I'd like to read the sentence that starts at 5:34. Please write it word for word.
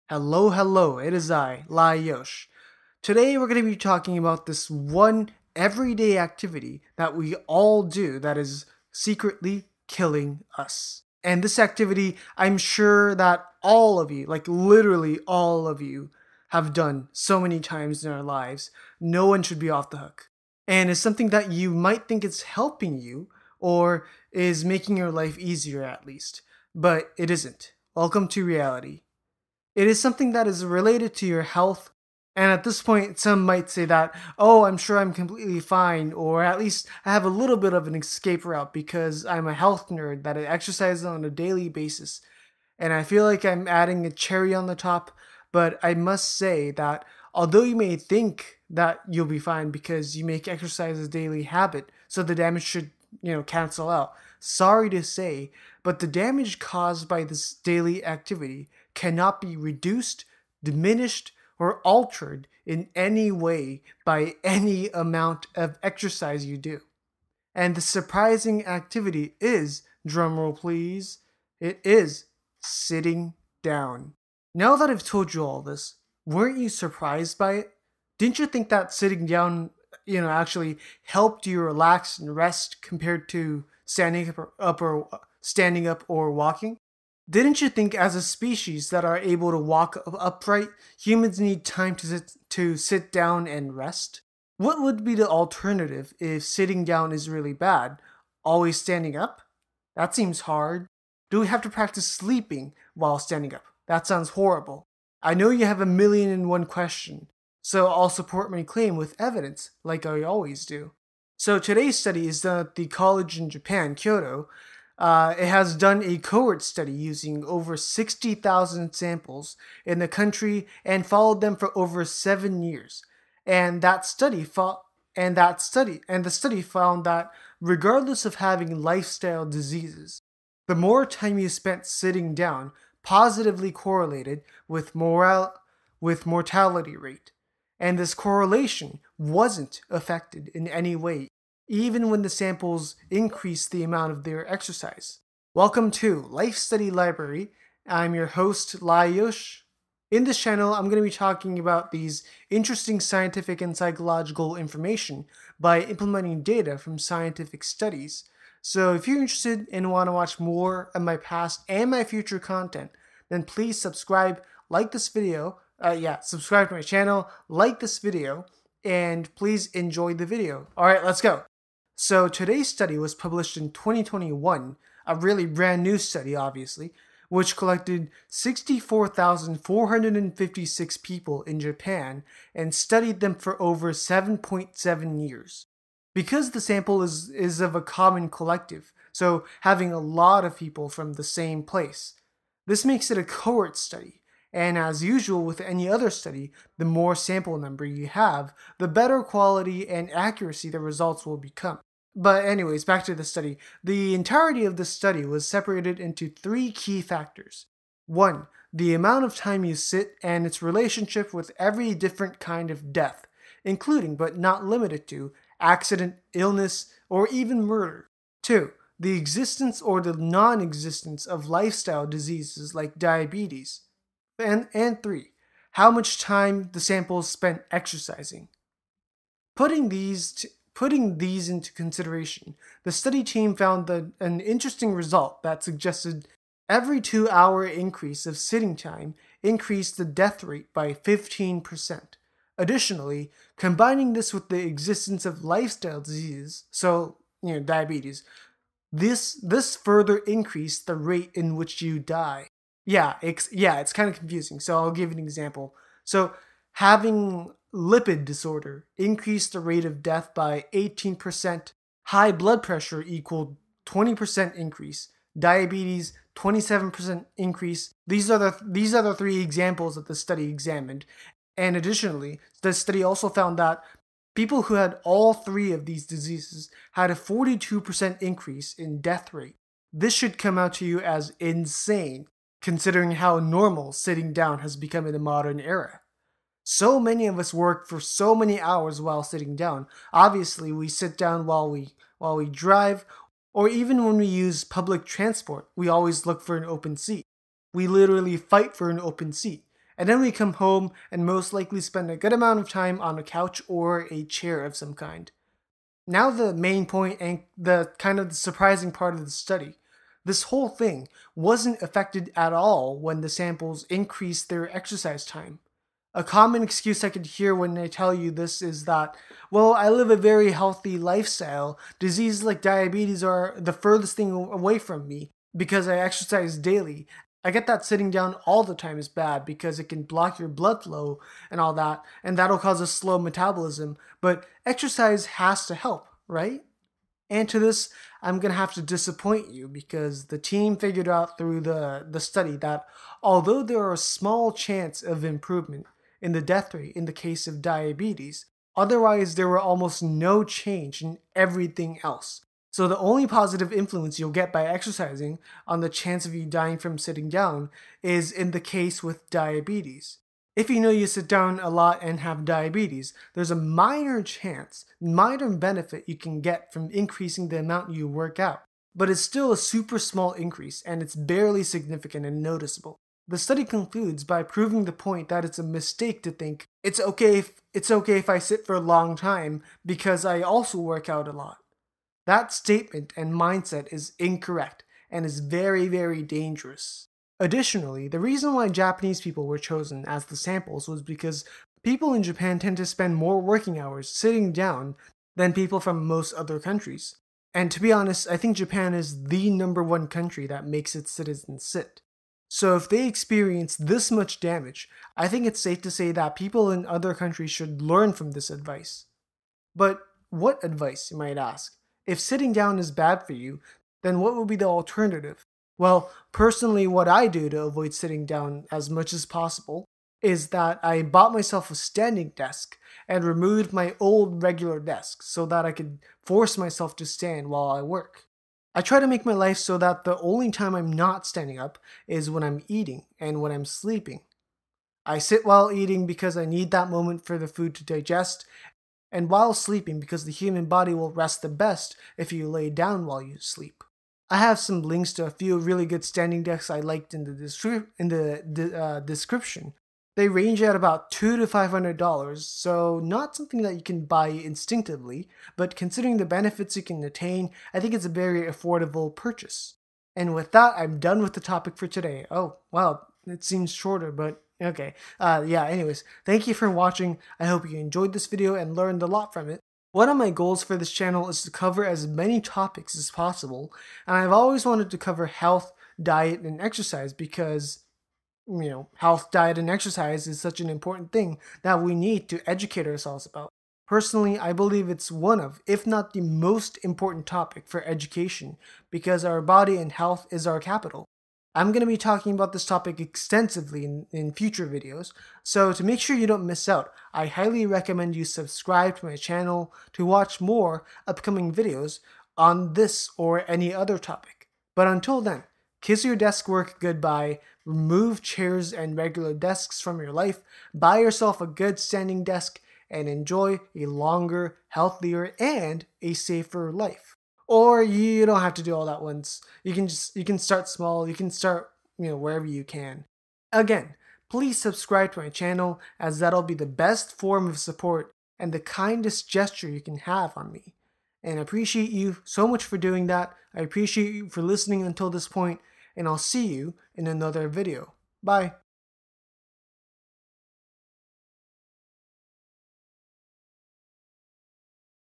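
But exercise has to help, right?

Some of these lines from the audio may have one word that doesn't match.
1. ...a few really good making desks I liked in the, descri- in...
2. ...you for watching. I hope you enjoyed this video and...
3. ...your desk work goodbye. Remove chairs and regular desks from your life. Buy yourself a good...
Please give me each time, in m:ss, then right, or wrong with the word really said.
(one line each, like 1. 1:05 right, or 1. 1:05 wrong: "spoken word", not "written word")
1. 7:25 wrong: "standing", not "making"
2. 7:46 right
3. 8:26 right.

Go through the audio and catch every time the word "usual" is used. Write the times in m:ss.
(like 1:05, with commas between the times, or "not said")
3:15.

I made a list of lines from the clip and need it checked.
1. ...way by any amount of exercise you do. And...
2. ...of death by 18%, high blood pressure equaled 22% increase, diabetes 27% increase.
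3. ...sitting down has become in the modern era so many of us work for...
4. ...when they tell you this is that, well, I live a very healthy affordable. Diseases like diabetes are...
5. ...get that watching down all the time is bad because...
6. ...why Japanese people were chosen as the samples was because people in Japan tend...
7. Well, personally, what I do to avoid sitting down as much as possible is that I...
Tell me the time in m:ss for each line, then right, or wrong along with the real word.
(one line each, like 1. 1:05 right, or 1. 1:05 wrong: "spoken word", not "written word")
1. 1:03 right
2. 4:19 wrong: "20", not "22"
3. 4:43 right
4. 5:17 wrong: "lifestyle", not "affordable"
5. 5:27 wrong: "sitting", not "watching"
6. 6:28 right
7. 6:55 right.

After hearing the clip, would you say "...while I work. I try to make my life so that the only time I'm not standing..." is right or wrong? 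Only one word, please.
right.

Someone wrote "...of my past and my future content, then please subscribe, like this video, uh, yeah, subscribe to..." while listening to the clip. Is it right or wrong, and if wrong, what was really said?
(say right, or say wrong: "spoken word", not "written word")
right.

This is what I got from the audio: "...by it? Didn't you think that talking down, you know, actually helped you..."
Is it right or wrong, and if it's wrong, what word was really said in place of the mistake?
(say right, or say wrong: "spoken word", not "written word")
wrong: "sitting", not "talking".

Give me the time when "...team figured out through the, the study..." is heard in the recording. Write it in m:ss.
5:40.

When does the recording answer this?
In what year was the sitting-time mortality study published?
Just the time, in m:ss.
2:53.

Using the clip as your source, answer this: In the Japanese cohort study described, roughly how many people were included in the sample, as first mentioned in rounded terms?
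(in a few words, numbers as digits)
over 60,000.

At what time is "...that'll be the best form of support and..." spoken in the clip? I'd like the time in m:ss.
8:46.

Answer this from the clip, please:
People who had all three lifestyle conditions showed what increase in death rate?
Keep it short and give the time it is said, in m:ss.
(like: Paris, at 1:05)
42%, at 4:37.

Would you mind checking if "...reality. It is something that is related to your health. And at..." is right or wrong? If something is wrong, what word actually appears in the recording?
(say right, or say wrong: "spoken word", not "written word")
right.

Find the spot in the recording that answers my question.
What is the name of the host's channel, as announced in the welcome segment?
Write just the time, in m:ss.
2:26.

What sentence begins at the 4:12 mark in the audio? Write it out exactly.
Yeah, it's yeah, it's kind of confusing.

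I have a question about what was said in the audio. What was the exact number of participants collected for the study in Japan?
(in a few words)
64,456.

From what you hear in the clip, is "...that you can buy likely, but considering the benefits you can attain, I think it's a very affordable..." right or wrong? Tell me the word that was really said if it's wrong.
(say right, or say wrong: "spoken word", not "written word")
wrong: "instinctively", not "likely".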